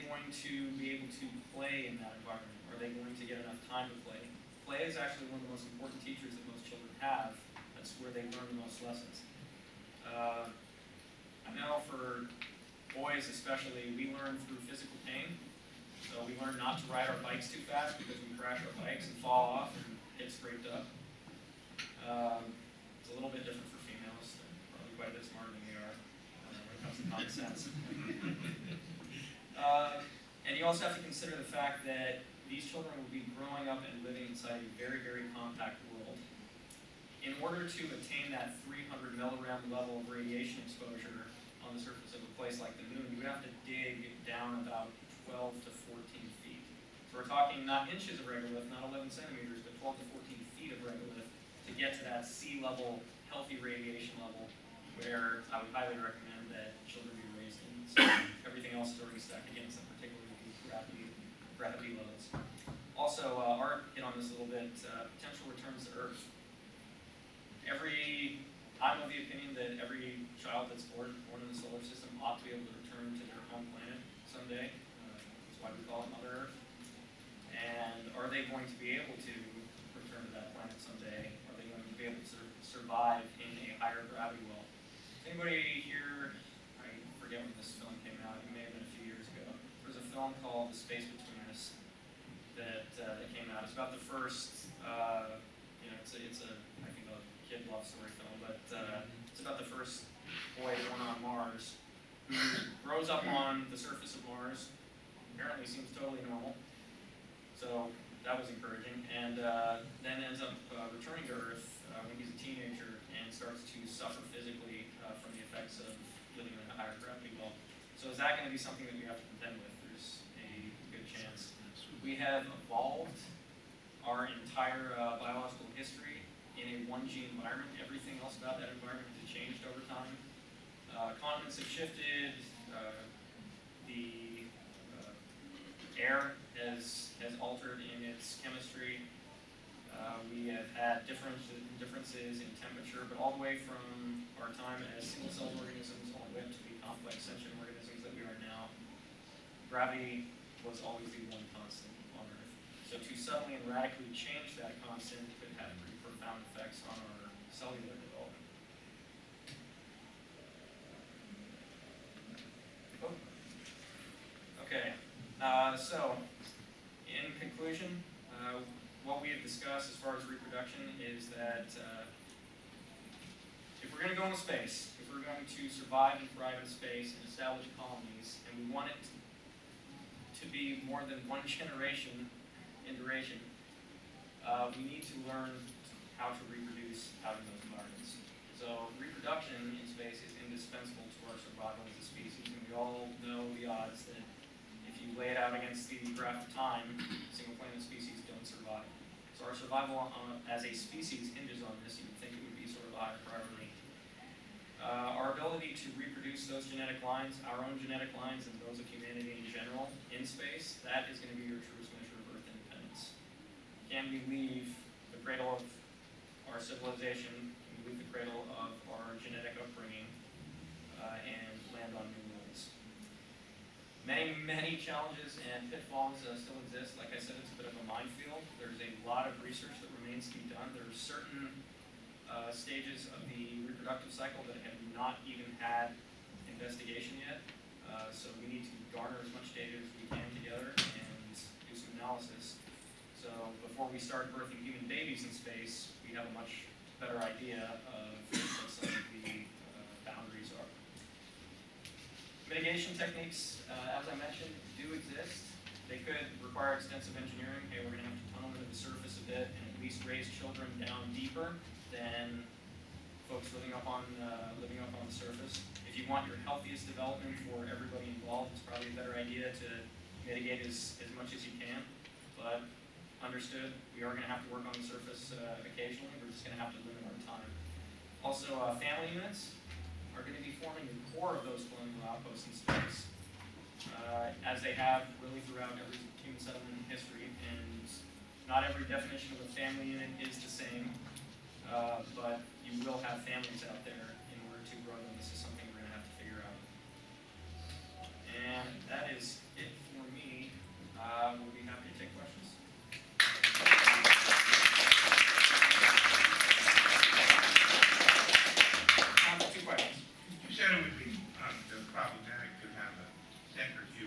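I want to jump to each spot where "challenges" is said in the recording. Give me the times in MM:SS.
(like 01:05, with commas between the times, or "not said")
03:44.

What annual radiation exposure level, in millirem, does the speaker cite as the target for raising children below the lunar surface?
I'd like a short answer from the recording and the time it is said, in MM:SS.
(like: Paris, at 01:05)
300 millirem, at 00:38.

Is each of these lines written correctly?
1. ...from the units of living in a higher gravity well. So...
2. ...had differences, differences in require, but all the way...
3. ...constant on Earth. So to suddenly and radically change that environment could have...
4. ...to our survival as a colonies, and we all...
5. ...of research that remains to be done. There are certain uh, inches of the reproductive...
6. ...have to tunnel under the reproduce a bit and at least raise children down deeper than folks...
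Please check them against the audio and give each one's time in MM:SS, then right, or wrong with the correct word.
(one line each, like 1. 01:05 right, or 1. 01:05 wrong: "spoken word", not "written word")
1. 01:55 wrong: "effects", not "units"
2. 02:20 wrong: "temperature", not "require"
3. 02:31 wrong: "constant", not "environment"
4. 03:11 wrong: "species", not "colonies"
5. 03:49 wrong: "stages", not "inches"
6. 04:18 wrong: "surface", not "reproduce".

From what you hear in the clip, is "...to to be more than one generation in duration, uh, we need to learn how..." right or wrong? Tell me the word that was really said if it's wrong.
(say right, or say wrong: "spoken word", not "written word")
right.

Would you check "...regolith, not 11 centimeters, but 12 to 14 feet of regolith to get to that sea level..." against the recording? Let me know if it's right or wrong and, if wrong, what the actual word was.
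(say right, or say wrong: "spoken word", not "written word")
right.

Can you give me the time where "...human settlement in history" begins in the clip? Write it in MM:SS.
04:46.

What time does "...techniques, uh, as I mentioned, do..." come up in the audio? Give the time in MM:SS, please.
04:12.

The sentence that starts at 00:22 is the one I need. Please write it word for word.
Um, it's a little bit different for females.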